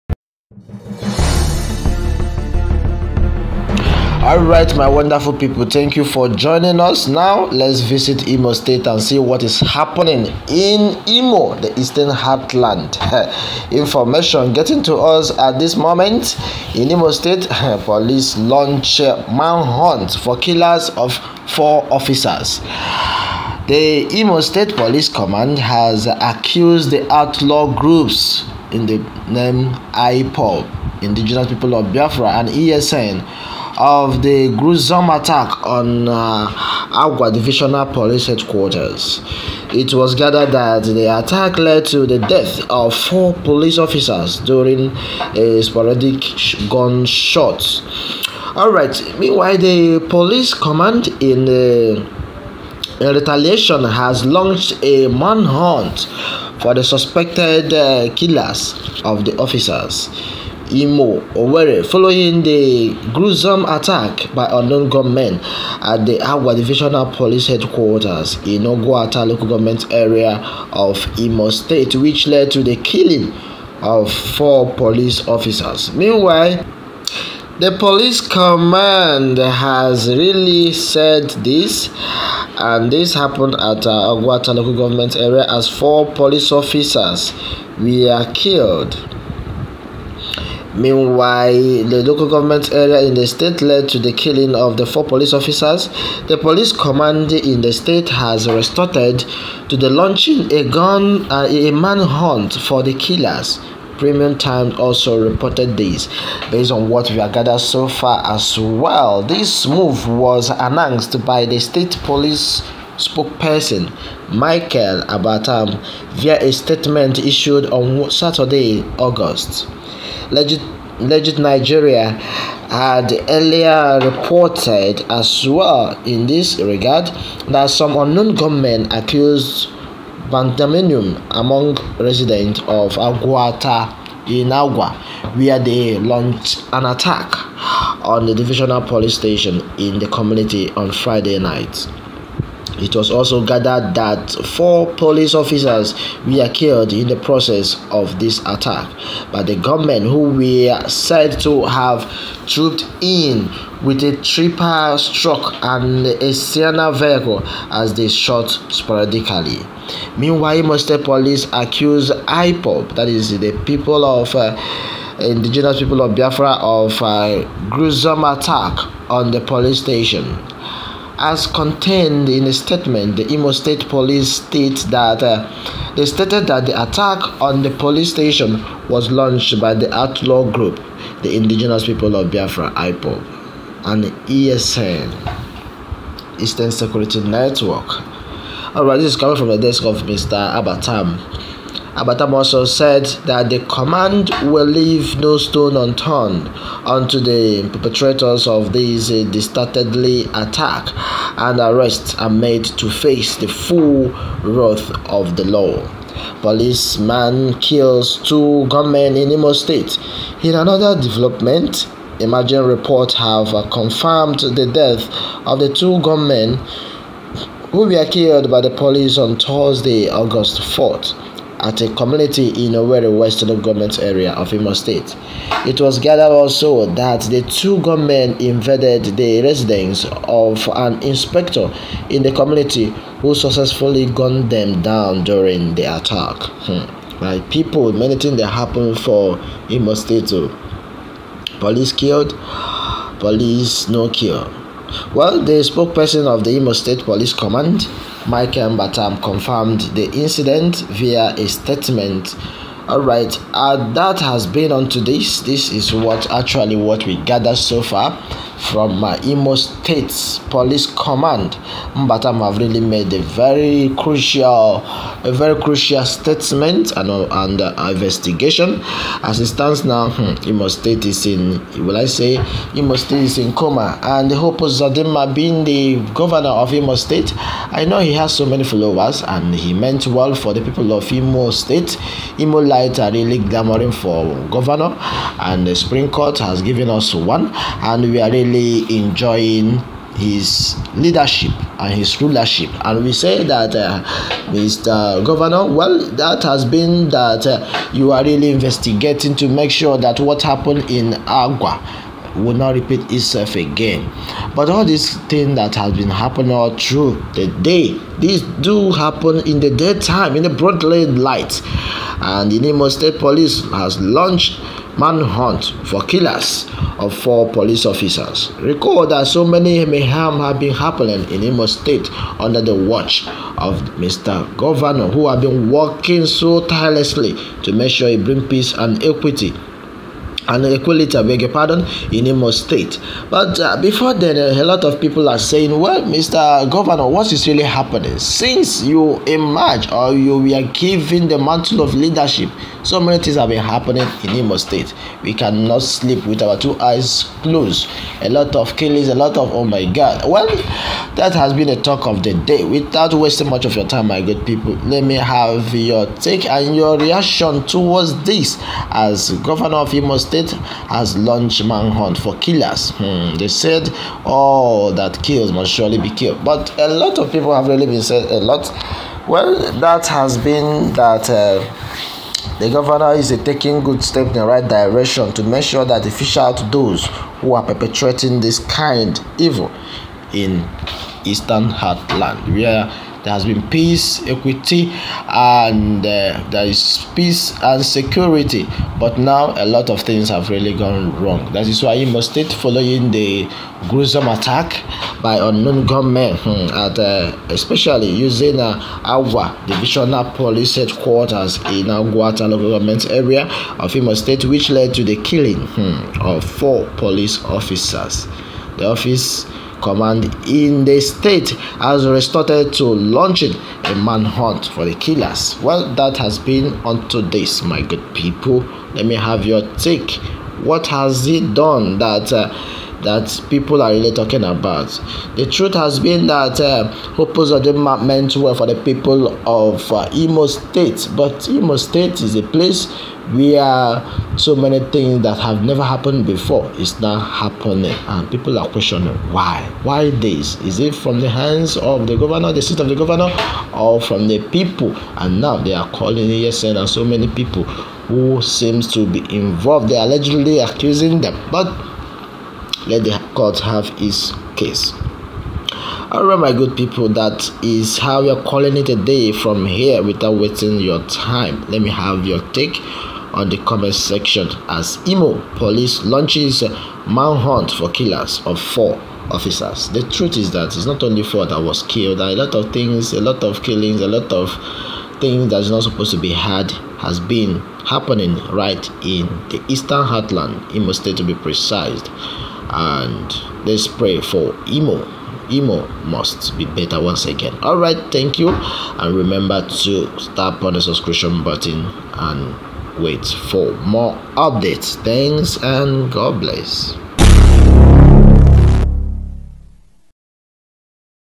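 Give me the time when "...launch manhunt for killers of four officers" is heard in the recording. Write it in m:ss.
0:18.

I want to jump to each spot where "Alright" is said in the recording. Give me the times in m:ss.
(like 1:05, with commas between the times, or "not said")
0:48, 3:08, 7:36.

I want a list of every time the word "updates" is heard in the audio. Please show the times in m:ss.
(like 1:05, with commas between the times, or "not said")
8:14.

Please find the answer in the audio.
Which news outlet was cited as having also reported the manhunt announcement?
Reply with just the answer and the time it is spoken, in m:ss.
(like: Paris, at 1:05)
Premium Times, at 1:43.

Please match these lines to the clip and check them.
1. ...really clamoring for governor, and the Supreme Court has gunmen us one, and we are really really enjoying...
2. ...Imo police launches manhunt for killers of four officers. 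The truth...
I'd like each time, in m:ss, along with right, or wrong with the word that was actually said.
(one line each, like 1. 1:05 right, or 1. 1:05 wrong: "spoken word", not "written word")
1. 4:43 wrong: "given", not "gunmen"
2. 7:45 right.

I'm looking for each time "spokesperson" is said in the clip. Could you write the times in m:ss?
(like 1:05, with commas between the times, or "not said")
1:52, 4:05.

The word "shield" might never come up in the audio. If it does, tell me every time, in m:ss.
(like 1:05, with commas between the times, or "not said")
not said.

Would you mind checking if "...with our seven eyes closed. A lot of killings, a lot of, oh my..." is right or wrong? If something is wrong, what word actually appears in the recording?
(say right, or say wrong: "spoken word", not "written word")
wrong: "two", not "seven".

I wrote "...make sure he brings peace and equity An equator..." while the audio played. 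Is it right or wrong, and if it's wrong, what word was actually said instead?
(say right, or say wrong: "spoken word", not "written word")
right.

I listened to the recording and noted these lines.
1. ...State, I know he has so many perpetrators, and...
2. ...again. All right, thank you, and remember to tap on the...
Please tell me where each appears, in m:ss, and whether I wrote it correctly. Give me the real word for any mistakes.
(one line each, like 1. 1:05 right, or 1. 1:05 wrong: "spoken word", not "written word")
1. 4:36 wrong: "followers", not "perpetrators"
2. 8:07 right.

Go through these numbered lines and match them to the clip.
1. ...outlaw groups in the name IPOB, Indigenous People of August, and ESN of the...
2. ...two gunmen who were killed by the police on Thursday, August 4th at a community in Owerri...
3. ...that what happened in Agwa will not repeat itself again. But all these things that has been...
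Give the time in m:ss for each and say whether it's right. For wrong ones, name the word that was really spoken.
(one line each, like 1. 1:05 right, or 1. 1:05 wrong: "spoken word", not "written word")
1. 0:27 wrong: "Biafra", not "August"
2. 3:35 right
3. 4:59 right.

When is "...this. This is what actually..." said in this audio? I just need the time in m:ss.
4:15.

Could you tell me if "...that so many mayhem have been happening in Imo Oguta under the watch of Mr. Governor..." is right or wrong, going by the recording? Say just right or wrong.
wrong.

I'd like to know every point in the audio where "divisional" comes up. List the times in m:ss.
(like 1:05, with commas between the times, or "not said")
0:37, 1:06, 2:18, 6:39.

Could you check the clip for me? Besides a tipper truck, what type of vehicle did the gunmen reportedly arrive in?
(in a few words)
Sienna.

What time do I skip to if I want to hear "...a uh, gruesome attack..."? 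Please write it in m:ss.
2:47.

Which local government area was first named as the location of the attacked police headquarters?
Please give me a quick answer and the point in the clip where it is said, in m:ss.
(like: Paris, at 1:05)
Oguta, at 1:08.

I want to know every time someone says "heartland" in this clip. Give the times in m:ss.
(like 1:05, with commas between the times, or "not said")
0:12, 6:21, 8:00.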